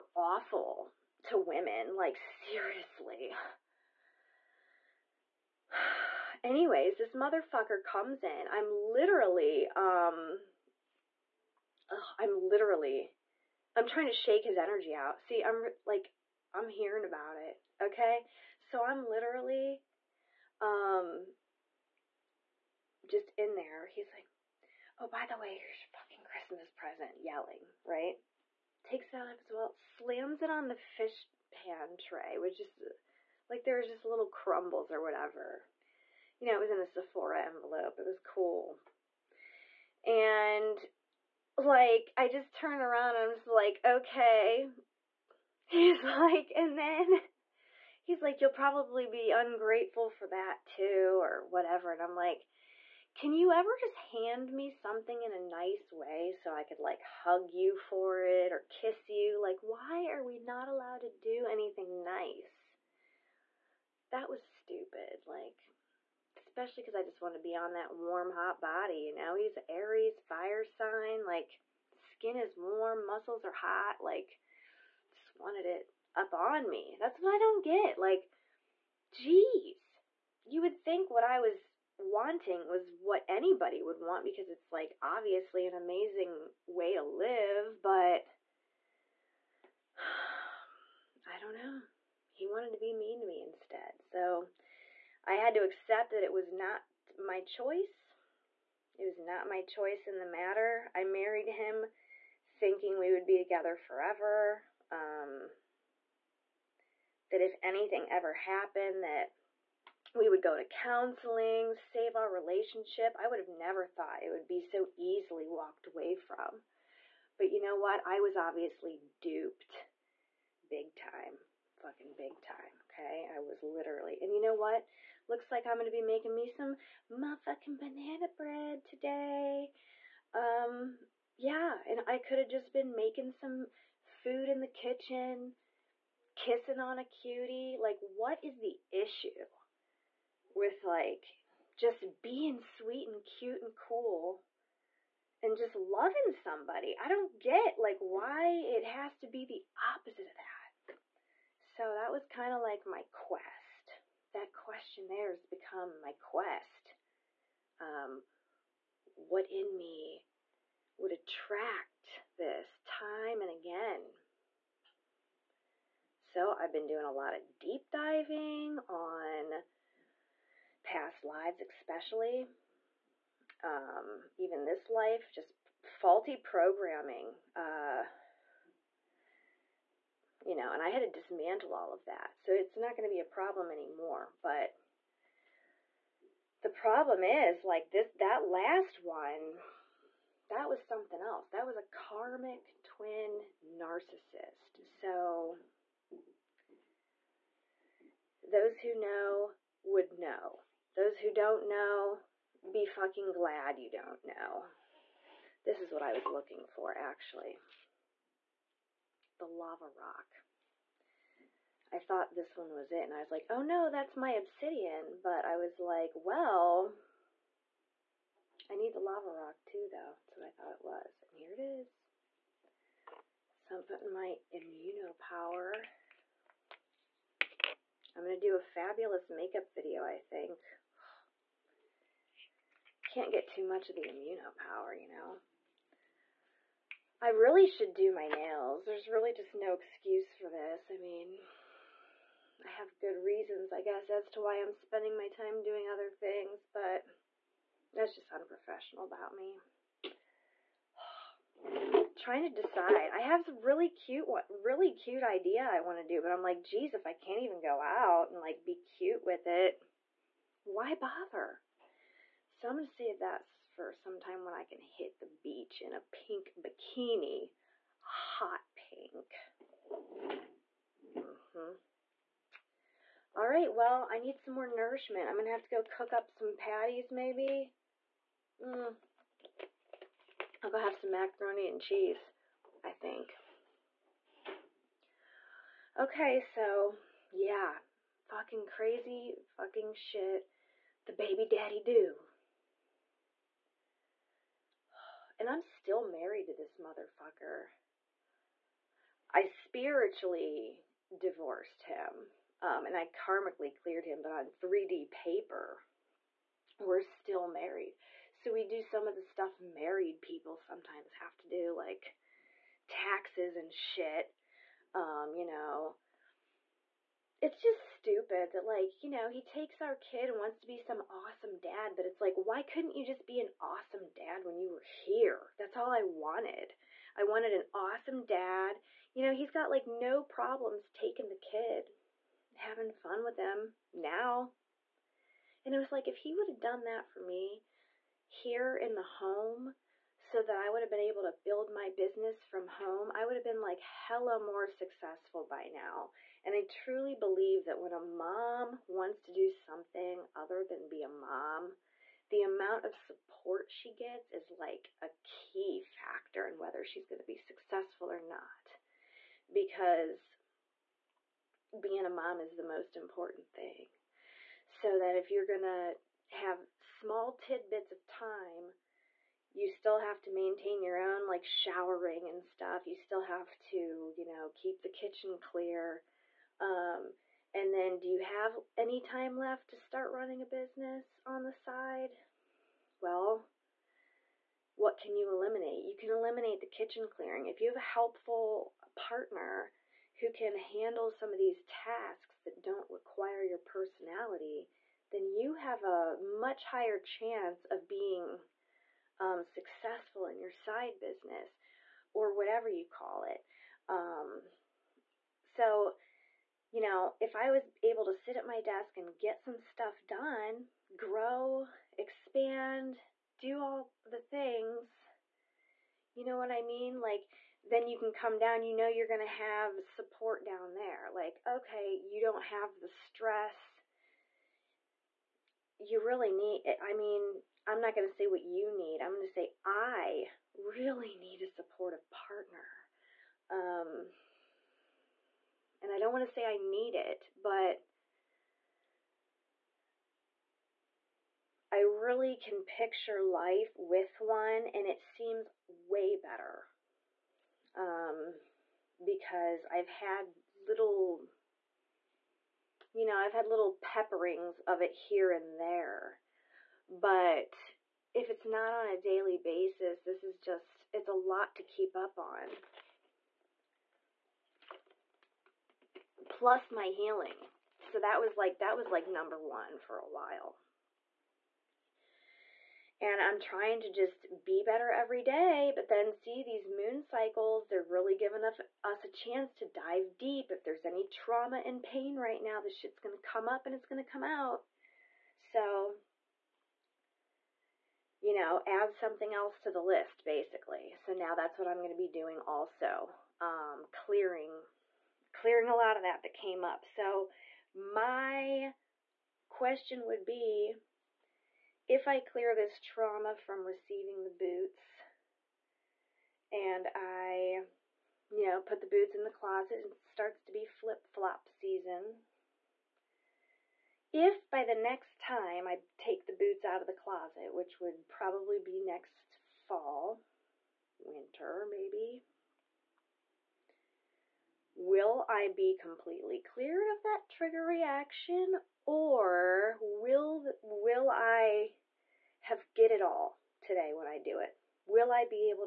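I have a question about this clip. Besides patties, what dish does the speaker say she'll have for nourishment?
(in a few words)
Macaroni and cheese.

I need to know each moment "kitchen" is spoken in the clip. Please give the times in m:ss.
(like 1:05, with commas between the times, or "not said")
2:14, 6:14, 6:26.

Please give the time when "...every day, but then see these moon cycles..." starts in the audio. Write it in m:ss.
7:54.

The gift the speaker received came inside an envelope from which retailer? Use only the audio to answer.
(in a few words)
Sephora.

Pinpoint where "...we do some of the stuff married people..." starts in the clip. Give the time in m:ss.
5:08.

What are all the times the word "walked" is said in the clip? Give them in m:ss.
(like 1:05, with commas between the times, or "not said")
1:55.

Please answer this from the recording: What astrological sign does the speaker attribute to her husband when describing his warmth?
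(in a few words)
Aries.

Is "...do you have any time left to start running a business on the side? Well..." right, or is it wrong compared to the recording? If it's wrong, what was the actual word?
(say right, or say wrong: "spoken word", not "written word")
right.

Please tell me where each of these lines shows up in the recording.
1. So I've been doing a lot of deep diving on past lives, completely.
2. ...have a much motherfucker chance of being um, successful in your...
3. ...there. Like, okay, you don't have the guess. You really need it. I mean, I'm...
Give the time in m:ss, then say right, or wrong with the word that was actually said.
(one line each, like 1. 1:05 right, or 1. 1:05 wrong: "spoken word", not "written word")
1. 2:46 wrong: "especially", not "completely"
2. 6:35 wrong: "higher", not "motherfucker"
3. 7:00 wrong: "stress", not "guess".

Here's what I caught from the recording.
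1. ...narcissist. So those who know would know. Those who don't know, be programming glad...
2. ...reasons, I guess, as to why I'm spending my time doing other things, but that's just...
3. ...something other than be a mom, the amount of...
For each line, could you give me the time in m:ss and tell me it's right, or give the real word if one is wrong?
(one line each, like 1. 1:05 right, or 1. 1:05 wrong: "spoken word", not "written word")
1. 3:13 wrong: "fucking", not "programming"
2. 4:03 right
3. 5:49 right.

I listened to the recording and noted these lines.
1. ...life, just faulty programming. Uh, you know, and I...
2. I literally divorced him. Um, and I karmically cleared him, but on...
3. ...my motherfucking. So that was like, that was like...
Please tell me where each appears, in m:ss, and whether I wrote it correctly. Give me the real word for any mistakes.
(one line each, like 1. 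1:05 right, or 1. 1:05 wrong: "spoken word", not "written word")
1. 2:54 right
2. 4:59 wrong: "spiritually", not "literally"
3. 7:46 wrong: "healing", not "motherfucking".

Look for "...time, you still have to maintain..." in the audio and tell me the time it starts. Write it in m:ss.
6:08.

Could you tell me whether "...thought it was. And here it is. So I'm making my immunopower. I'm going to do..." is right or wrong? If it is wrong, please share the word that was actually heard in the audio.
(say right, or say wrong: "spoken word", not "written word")
wrong: "putting", not "making".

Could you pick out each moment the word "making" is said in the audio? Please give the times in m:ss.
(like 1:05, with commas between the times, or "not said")
2:06, 2:12.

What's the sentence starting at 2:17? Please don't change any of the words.
Like, what is the issue with, like, just being sweet and cute and cool and just loving somebody?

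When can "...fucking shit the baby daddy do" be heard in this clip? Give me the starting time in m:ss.
4:49.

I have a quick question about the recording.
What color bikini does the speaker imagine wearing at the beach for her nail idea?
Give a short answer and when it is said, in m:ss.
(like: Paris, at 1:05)
Hot pink, at 4:28.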